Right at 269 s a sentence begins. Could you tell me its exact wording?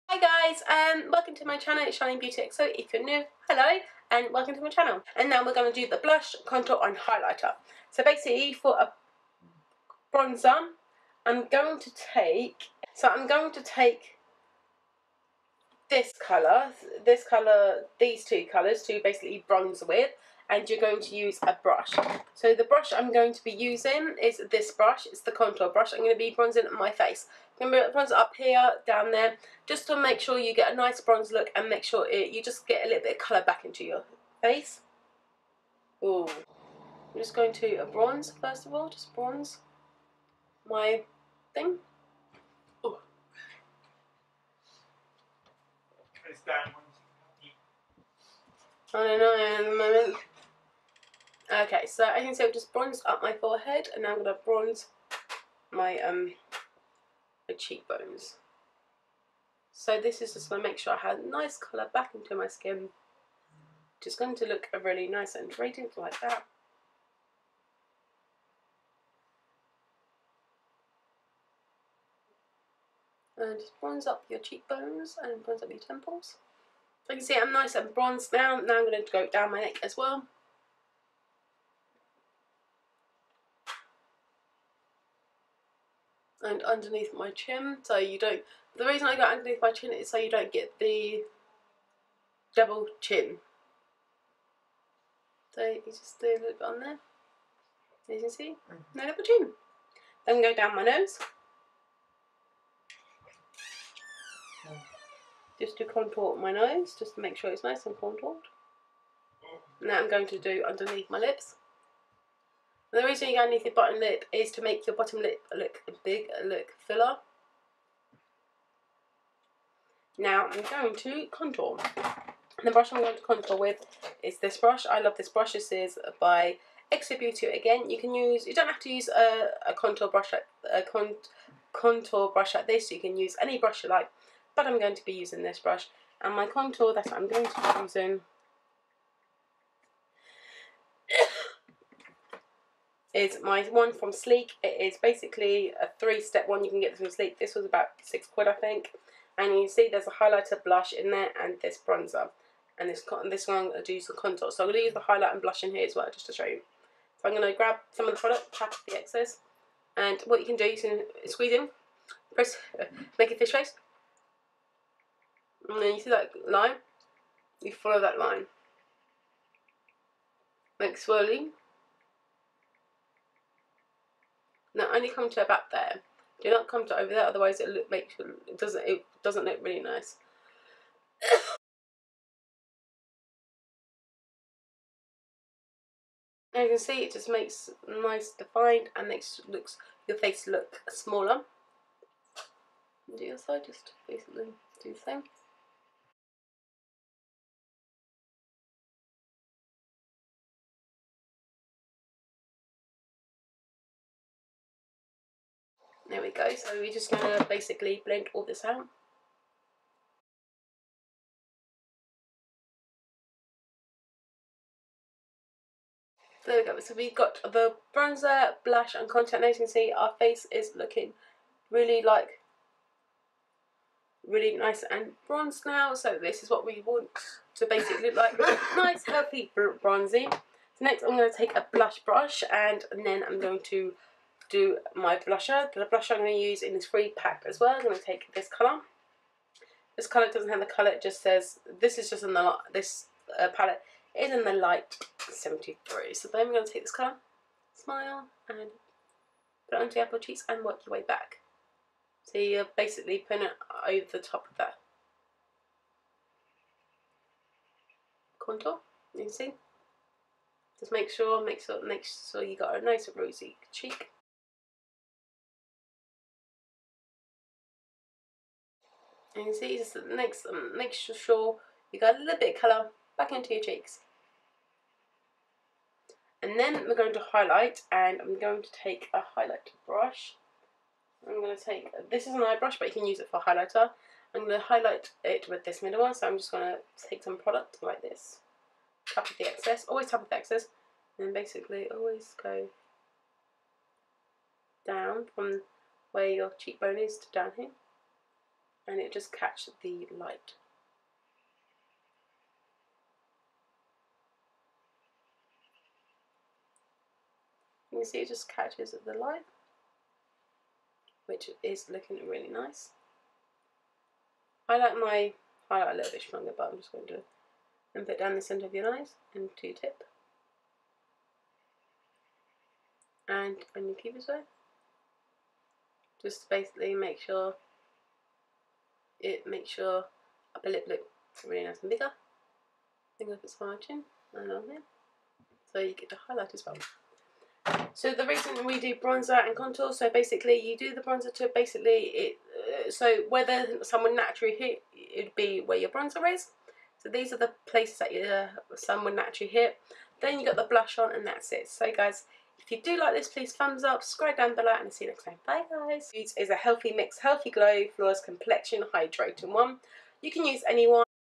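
And you can see just makes, um, makes sure you got a little bit of colour back into your cheeks.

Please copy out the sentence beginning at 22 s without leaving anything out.
So the brush I'm going to be using is this brush, it's the contour brush.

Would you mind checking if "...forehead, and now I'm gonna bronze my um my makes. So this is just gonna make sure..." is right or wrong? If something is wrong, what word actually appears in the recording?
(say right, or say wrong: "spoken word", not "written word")
wrong: "cheekbones", not "makes".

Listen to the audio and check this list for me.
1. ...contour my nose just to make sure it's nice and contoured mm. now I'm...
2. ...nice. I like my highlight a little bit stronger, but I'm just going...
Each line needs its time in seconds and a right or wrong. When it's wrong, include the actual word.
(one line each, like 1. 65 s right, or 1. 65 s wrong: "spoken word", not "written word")
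1. 105 s right
2. 312 s right.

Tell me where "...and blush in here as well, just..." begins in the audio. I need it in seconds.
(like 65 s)
155 s.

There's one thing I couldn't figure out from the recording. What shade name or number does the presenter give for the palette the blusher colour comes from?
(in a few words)
light 73.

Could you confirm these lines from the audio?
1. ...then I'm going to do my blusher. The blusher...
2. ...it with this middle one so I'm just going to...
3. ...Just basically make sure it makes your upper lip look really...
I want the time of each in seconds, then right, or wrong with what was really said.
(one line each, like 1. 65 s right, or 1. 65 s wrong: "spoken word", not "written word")
1. 233 s right
2. 285 s right
3. 326 s right.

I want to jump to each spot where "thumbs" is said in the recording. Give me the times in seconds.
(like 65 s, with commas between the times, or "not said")
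353 s.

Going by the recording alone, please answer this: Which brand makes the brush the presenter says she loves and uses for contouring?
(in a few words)
Extra Beauty.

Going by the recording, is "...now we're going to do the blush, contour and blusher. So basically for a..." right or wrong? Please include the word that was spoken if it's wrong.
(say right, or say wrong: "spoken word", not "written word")
wrong: "highlighter", not "blusher".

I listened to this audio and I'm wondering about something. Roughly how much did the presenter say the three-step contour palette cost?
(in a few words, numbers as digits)
about six quid.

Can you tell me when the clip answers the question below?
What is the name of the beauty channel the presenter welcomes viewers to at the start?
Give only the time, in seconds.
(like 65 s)
1 s.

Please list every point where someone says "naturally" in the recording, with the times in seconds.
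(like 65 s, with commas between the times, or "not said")
344 s, 349 s.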